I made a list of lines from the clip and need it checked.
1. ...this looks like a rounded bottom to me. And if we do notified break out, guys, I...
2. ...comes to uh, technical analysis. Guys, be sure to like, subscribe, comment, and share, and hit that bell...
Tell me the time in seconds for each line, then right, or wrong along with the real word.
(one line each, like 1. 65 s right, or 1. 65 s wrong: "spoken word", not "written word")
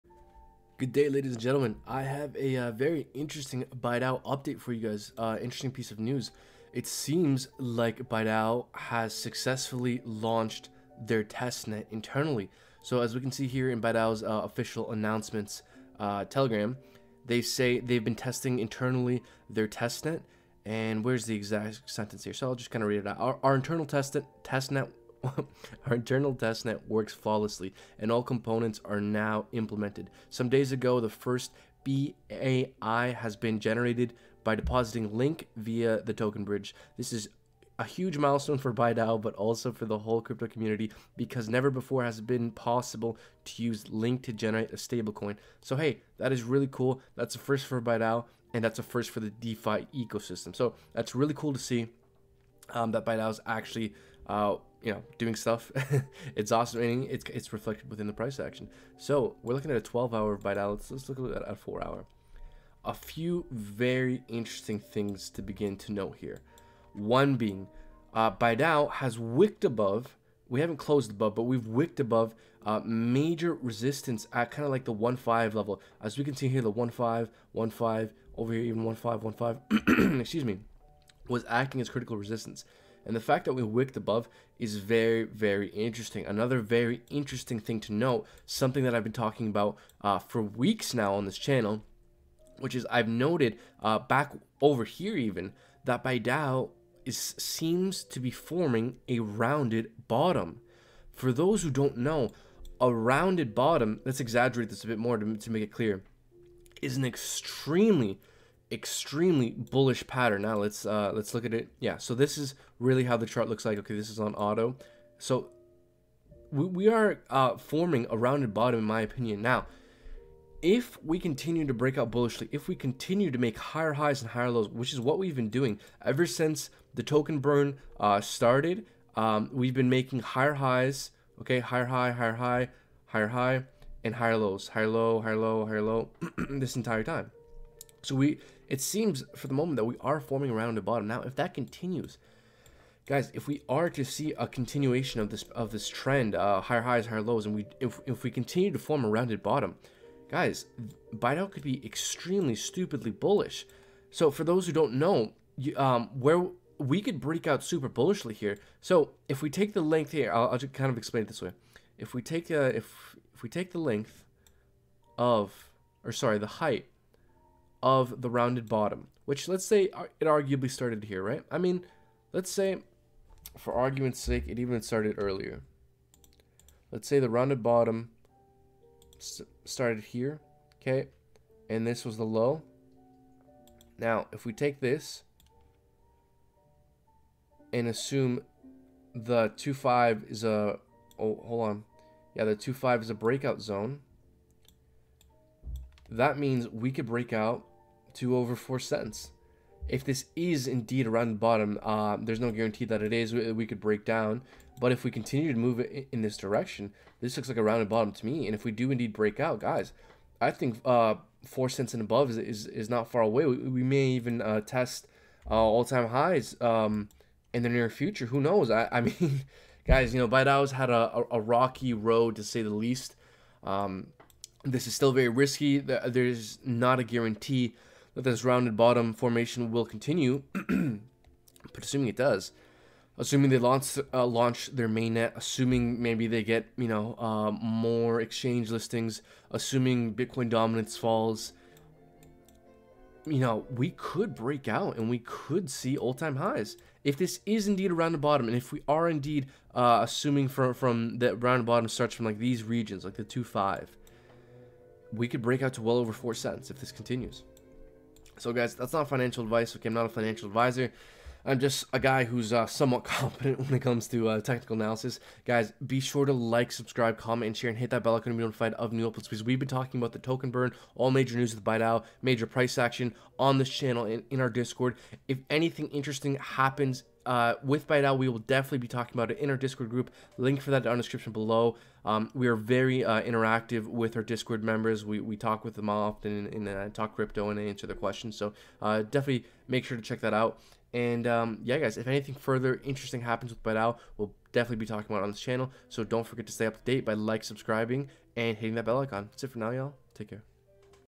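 1. 207 s wrong: "indeed", not "notified"
2. 263 s right.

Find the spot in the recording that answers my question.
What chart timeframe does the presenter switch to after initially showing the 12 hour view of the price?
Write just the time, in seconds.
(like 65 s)
61 s.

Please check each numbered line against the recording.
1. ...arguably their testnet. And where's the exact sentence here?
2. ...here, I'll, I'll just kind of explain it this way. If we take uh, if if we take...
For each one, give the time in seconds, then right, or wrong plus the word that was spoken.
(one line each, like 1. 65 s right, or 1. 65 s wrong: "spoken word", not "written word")
1. 18 s wrong: "internally", not "arguably"
2. 160 s right.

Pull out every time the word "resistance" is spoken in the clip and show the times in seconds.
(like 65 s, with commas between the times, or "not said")
73 s, 82 s.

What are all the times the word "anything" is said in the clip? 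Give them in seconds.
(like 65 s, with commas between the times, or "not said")
275 s, 292 s.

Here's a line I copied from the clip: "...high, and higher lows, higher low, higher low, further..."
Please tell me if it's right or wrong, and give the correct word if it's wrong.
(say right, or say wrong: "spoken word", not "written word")
wrong: "higher", not "further".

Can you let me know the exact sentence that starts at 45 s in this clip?
So hey, that is really cool.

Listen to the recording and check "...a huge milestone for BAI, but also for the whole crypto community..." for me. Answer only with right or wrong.
wrong.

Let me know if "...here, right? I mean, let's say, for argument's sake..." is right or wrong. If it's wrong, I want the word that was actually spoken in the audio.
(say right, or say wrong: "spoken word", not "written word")
right.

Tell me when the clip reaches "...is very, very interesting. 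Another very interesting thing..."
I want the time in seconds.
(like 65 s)
84 s.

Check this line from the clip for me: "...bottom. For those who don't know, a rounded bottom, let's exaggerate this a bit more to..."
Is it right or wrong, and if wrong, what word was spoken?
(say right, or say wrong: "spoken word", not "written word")
right.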